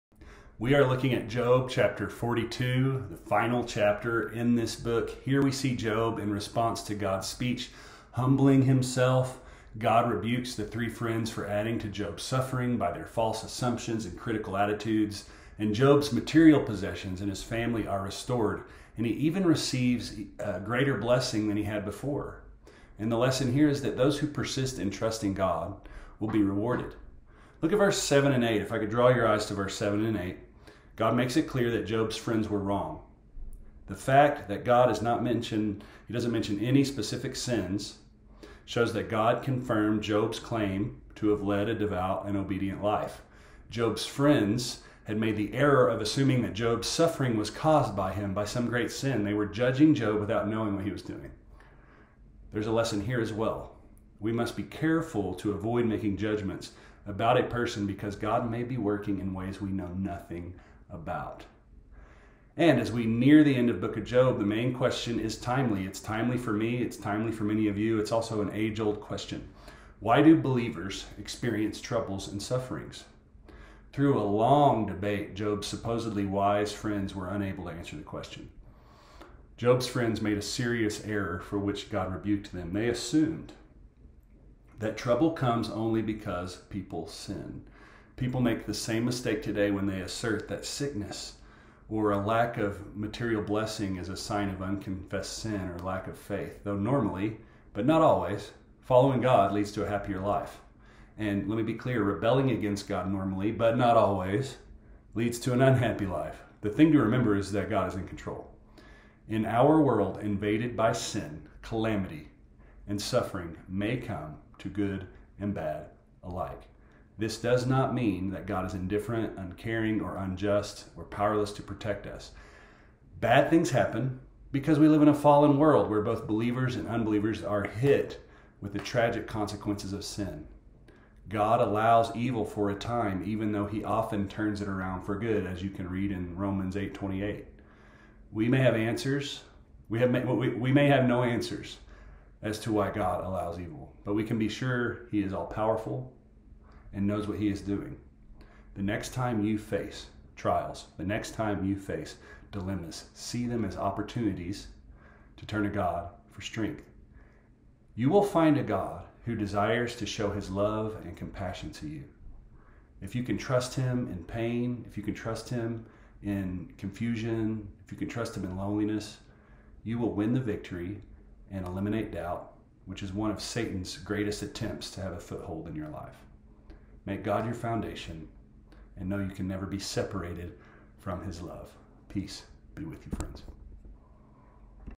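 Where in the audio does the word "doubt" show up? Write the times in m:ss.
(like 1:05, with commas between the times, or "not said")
2:52.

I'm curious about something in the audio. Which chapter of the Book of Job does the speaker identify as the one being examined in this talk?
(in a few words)
42.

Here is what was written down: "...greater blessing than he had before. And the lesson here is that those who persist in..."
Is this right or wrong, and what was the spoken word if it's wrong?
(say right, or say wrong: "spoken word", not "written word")
right.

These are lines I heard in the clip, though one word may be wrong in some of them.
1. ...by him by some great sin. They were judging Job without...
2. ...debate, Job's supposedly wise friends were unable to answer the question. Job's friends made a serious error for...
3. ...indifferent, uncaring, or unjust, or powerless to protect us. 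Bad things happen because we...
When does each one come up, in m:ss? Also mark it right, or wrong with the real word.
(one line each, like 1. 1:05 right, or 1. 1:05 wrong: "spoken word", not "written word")
1. 0:47 right
2. 1:14 right
3. 1:58 right.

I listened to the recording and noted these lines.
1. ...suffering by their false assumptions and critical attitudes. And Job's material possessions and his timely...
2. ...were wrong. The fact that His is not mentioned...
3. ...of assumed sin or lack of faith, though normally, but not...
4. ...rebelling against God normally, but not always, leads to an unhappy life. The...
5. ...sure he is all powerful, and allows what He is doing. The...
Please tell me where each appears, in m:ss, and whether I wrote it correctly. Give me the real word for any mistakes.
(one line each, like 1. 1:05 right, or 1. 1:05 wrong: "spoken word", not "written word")
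1. 0:12 wrong: "family", not "timely"
2. 0:32 wrong: "God", not "His"
3. 1:34 wrong: "unconfessed", not "assumed"
4. 1:42 right
5. 2:24 wrong: "knows", not "allows".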